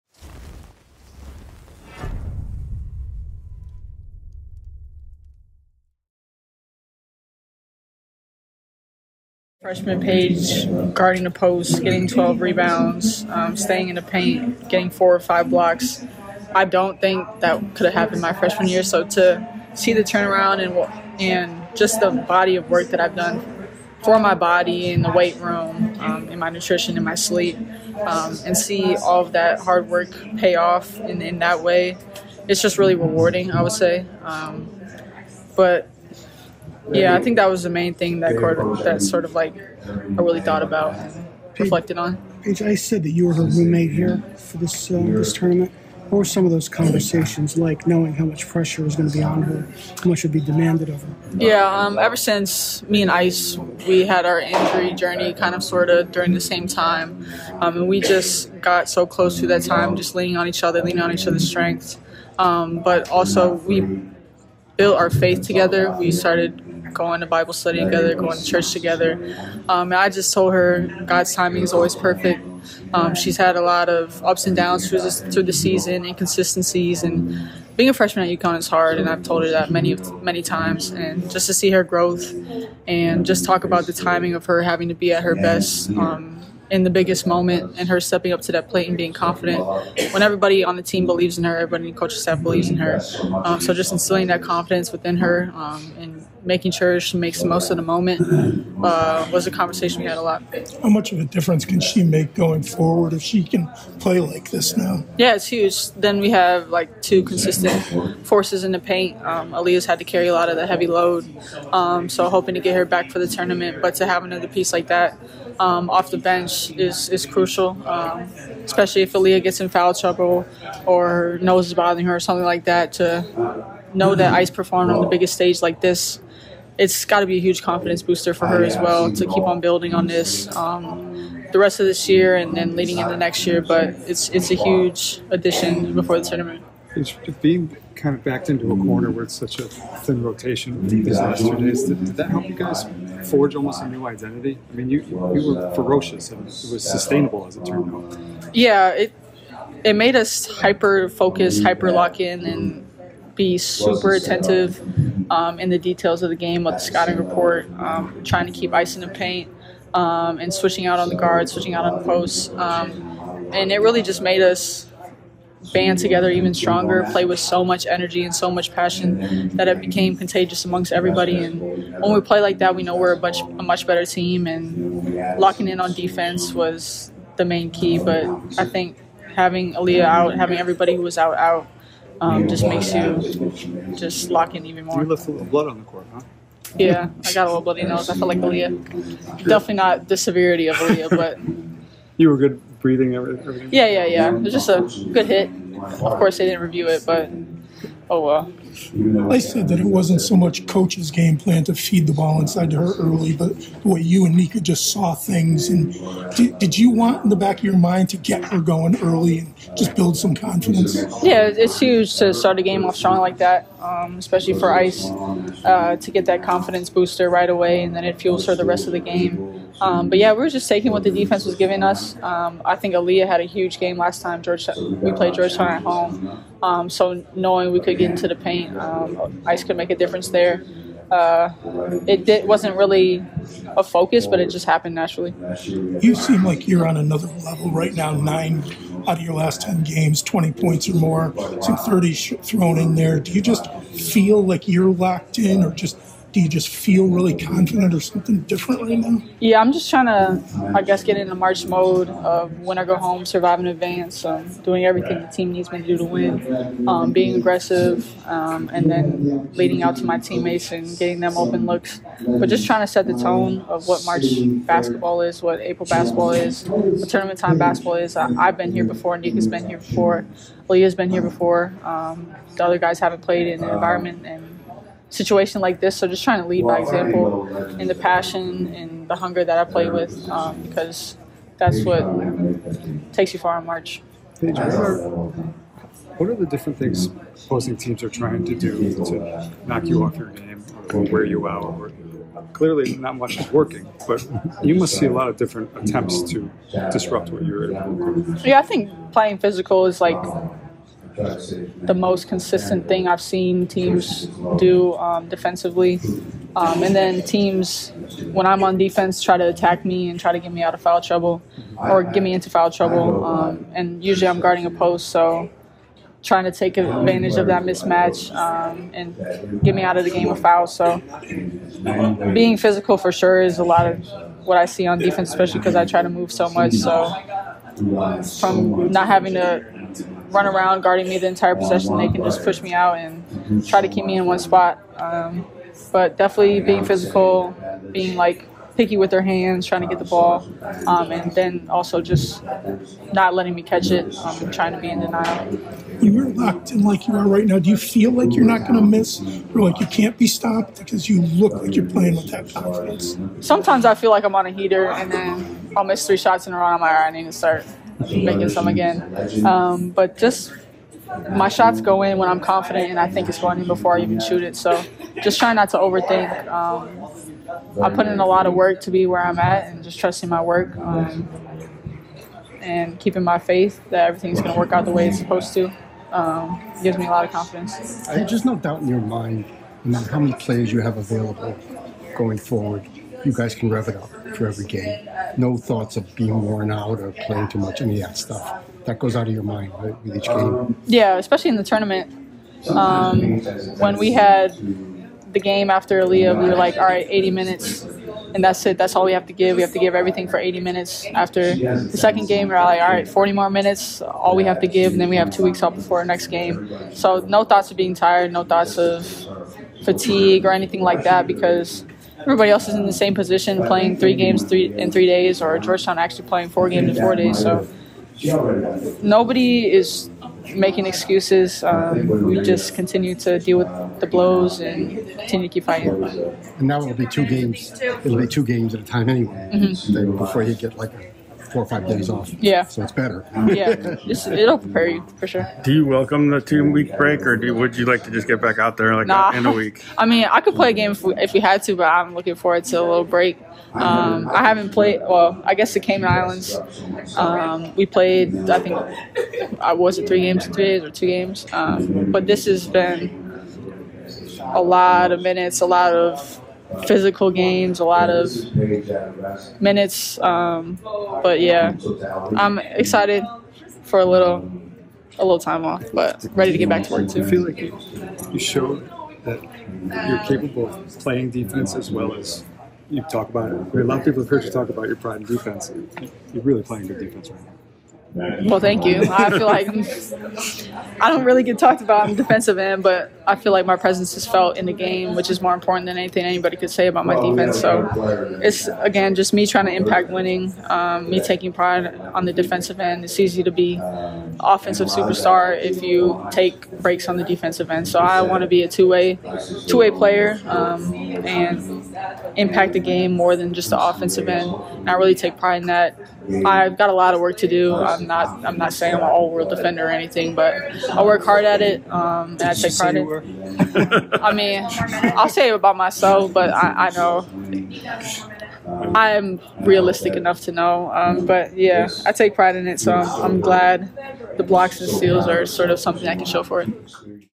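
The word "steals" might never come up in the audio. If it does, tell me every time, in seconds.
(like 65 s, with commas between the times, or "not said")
524 s.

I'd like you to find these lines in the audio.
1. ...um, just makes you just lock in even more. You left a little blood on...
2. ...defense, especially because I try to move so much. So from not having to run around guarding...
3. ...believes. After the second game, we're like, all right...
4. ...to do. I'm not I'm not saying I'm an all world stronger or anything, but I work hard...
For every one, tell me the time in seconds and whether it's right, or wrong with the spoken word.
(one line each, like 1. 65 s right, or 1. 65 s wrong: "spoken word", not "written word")
1. 182 s right
2. 324 s right
3. 400 s wrong: "minutes", not "believes"
4. 507 s wrong: "defender", not "stronger".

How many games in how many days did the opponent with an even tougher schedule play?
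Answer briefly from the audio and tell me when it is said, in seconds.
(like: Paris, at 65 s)
4 games in 4 days, at 416 s.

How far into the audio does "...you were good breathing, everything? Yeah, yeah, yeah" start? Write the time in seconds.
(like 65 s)
192 s.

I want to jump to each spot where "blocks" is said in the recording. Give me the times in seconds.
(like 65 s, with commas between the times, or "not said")
15 s, 524 s.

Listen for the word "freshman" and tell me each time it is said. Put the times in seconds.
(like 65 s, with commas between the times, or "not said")
9 s, 18 s, 77 s.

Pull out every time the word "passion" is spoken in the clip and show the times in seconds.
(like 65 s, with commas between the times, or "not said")
168 s, 277 s.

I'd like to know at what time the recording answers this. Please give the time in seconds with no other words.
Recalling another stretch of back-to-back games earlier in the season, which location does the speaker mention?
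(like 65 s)
445 s.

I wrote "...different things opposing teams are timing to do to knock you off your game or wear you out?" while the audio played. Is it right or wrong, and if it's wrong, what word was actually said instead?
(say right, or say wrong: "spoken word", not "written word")
wrong: "trying", not "timing".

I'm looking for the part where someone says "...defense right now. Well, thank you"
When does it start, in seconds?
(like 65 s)
476 s.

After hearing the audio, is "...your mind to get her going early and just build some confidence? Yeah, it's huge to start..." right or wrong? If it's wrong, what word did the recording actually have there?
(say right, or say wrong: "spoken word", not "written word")
right.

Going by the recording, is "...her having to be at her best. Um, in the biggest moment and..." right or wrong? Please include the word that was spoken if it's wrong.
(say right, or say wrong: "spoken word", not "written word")
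right.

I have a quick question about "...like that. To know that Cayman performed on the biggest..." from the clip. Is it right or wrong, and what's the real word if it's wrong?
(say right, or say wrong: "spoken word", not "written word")
wrong: "Ice", not "Cayman".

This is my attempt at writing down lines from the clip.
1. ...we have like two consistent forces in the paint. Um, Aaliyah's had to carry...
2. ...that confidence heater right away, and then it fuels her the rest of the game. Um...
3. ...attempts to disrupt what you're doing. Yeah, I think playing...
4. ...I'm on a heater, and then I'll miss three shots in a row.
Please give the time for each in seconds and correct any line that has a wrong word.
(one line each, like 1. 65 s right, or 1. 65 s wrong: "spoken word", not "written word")
1. 106 s right
2. 216 s wrong: "booster", not "heater"
3. 295 s right
4. 354 s right.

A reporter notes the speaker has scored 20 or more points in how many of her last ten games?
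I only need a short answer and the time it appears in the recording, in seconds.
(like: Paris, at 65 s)
9, at 238 s.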